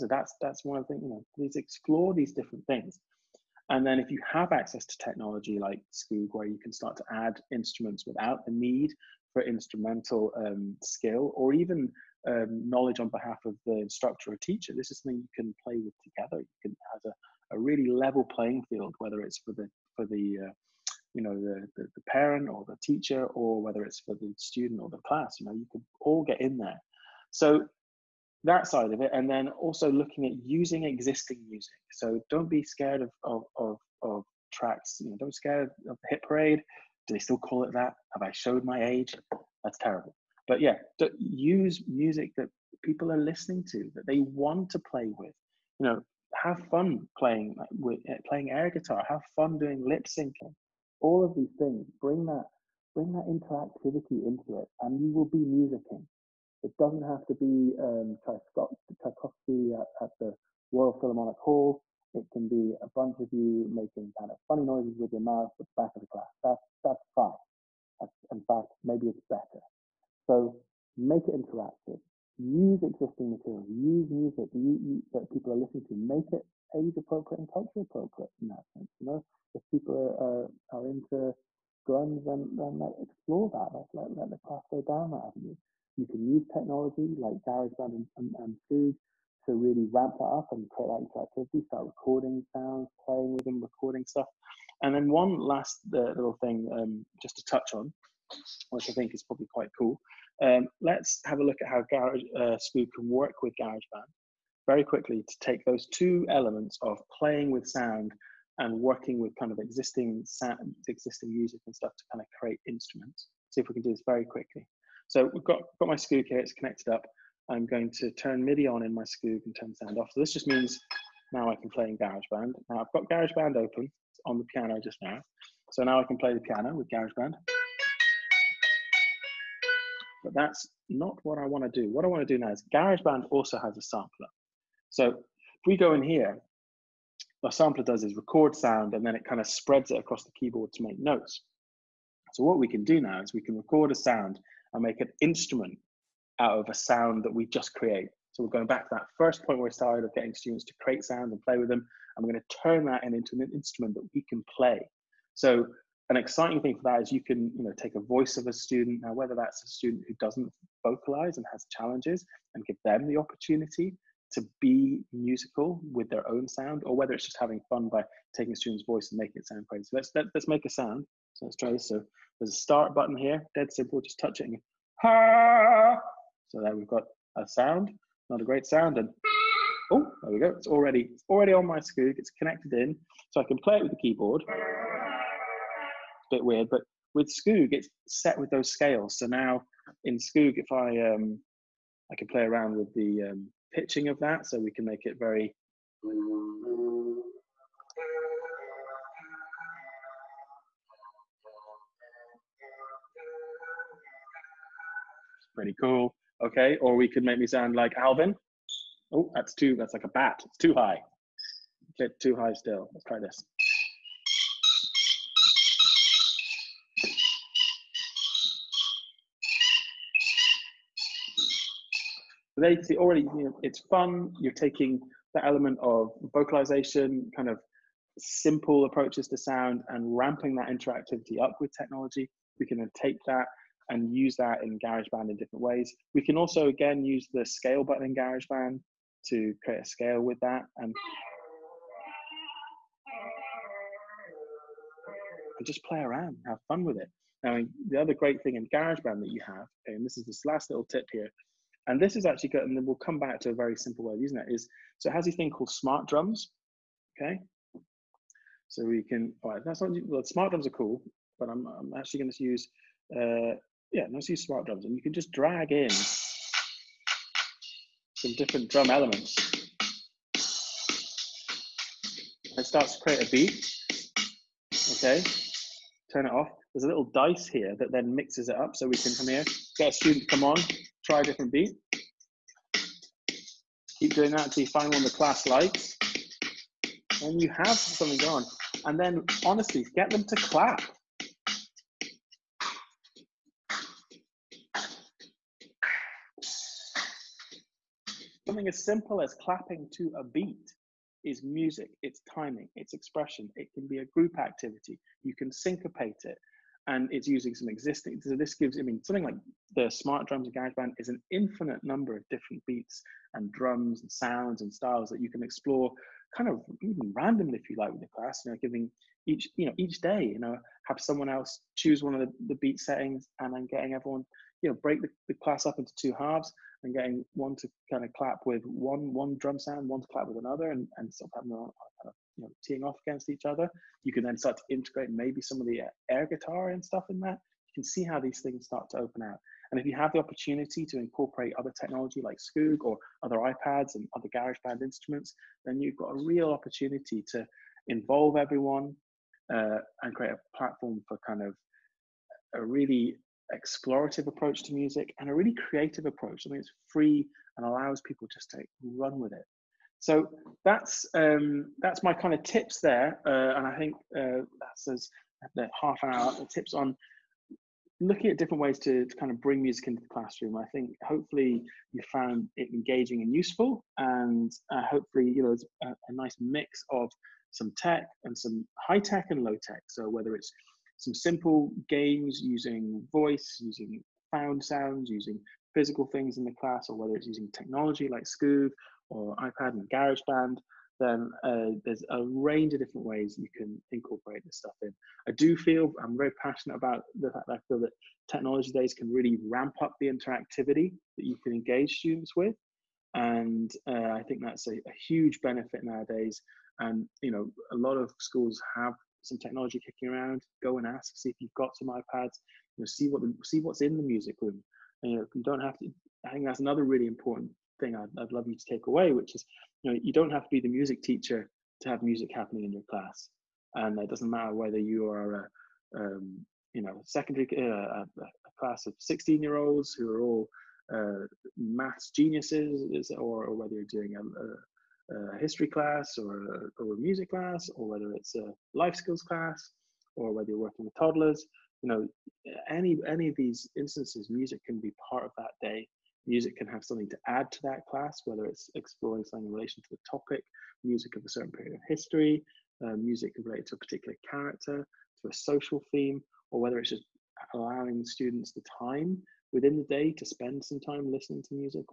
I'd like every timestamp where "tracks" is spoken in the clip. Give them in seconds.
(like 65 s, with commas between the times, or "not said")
34 s.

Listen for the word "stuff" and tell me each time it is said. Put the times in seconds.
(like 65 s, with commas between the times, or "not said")
94 s, 111 s, 336 s, 394 s.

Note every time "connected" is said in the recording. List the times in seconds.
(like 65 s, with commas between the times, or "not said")
116 s, 182 s.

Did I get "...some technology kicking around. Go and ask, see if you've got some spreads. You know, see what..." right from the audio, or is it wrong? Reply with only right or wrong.
wrong.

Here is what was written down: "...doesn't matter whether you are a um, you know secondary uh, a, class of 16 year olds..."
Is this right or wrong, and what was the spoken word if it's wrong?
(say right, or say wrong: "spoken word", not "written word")
right.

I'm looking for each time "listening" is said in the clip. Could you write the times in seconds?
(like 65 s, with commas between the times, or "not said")
43 s, 75 s, 461 s.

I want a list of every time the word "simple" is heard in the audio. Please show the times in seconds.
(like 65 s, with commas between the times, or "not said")
173 s, 228 s, 253 s, 298 s, 381 s.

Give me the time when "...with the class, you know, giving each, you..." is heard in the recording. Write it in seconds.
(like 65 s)
317 s.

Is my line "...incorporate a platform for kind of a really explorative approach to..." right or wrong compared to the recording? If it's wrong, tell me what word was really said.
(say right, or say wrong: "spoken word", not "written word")
wrong: "create", not "incorporate".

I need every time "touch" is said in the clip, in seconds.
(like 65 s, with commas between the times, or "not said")
97 s, 174 s.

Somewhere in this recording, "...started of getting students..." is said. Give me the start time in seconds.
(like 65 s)
149 s.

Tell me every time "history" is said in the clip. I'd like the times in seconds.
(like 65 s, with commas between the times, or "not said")
435 s, 451 s.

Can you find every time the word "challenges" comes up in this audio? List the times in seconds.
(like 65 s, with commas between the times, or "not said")
161 s.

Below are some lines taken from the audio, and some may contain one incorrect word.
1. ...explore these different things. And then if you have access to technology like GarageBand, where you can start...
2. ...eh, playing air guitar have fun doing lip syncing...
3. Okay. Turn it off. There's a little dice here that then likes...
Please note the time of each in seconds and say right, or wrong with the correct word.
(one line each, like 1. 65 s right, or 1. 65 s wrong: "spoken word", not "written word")
1. 1 s wrong: "Scoog", not "GarageBand"
2. 48 s right
3. 274 s wrong: "mixes", not "likes".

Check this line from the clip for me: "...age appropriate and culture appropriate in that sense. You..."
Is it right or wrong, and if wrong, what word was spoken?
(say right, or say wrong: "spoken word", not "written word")
right.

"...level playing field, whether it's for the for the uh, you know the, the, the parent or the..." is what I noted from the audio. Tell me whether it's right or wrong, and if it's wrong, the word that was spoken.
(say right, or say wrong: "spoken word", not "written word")
right.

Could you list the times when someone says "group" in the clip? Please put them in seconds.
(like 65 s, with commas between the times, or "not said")
304 s.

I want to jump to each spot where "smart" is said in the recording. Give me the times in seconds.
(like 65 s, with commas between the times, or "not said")
255 s, 260 s, 264 s, 309 s.